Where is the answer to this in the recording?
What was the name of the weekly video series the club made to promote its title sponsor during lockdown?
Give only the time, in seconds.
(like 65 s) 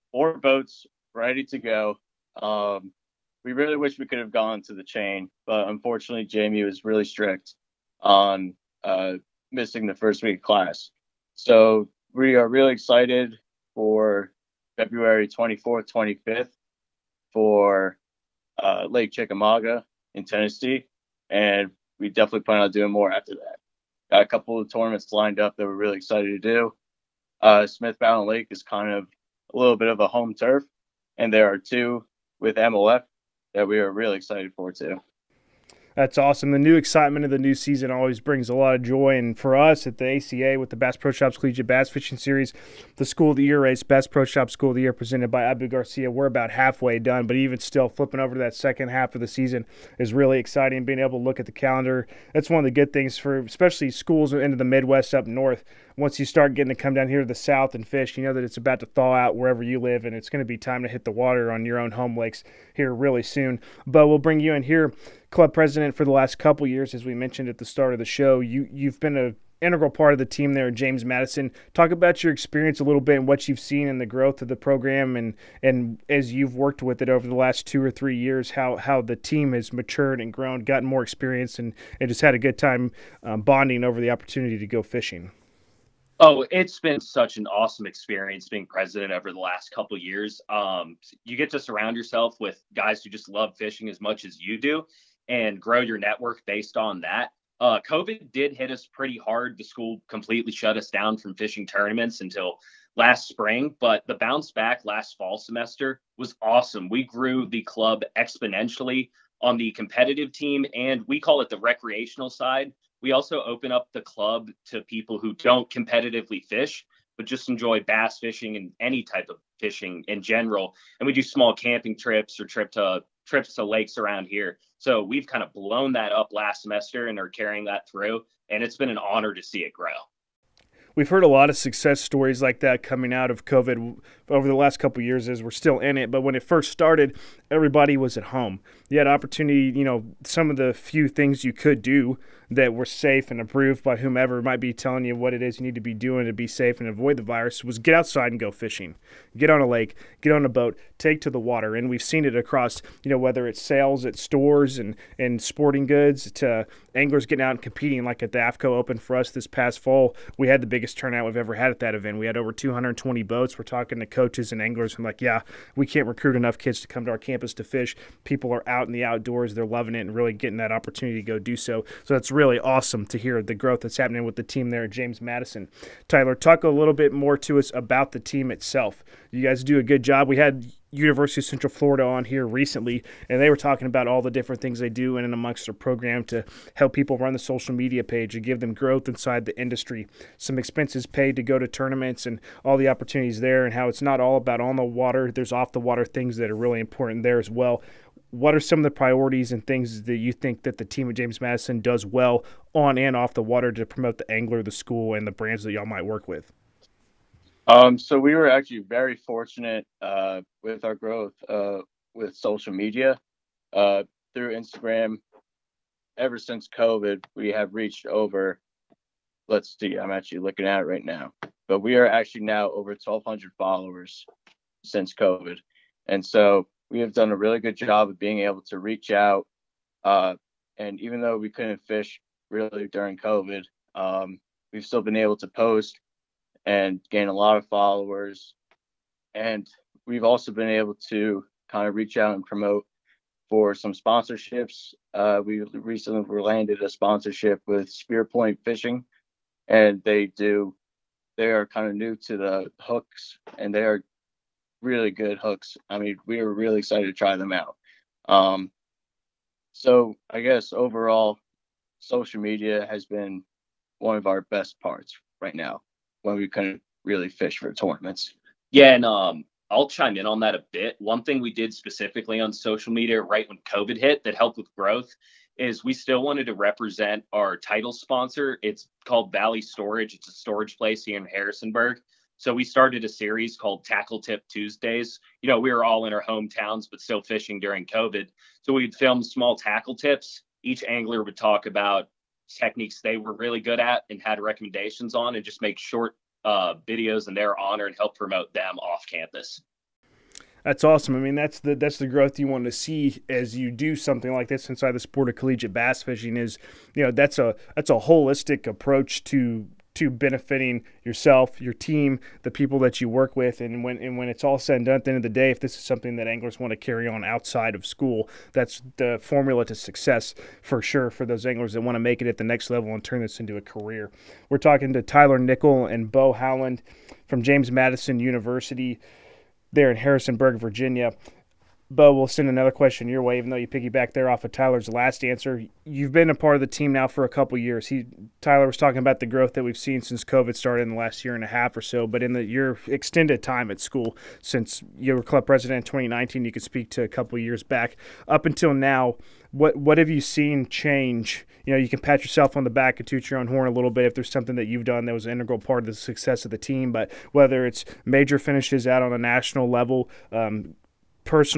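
283 s.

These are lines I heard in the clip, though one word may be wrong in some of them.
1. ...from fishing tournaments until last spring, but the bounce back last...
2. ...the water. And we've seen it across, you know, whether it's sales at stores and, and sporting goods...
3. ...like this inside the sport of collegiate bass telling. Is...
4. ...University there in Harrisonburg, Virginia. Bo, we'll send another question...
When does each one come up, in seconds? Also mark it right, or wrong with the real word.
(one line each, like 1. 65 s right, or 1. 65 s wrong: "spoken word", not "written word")
1. 101 s right
2. 151 s right
3. 304 s wrong: "fishing", not "telling"
4. 328 s right.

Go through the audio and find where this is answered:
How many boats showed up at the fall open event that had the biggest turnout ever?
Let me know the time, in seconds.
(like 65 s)
162 s.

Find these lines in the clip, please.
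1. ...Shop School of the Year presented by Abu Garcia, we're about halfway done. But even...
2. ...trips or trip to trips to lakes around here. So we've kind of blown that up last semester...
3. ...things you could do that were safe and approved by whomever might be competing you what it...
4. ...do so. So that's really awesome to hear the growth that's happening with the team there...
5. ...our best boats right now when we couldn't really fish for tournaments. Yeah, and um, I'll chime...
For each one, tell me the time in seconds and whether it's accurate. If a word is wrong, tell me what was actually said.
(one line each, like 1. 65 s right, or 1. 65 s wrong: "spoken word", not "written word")
1. 44 s right
2. 121 s right
3. 141 s wrong: "telling", not "competing"
4. 171 s right
5. 264 s wrong: "parts", not "boats".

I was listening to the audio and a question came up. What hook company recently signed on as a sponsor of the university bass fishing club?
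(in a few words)
Spearpoint Fishing.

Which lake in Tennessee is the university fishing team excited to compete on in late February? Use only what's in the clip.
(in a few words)
Lake Chickamauga.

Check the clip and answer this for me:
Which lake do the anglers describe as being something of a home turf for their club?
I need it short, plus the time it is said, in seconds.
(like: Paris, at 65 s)
Smith Mountain Lake, at 27 s.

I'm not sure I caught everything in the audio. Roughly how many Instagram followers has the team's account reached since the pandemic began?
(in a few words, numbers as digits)
over 1,200.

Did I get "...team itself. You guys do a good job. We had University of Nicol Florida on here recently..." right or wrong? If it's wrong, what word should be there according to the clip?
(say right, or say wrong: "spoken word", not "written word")
wrong: "Central", not "Nicol".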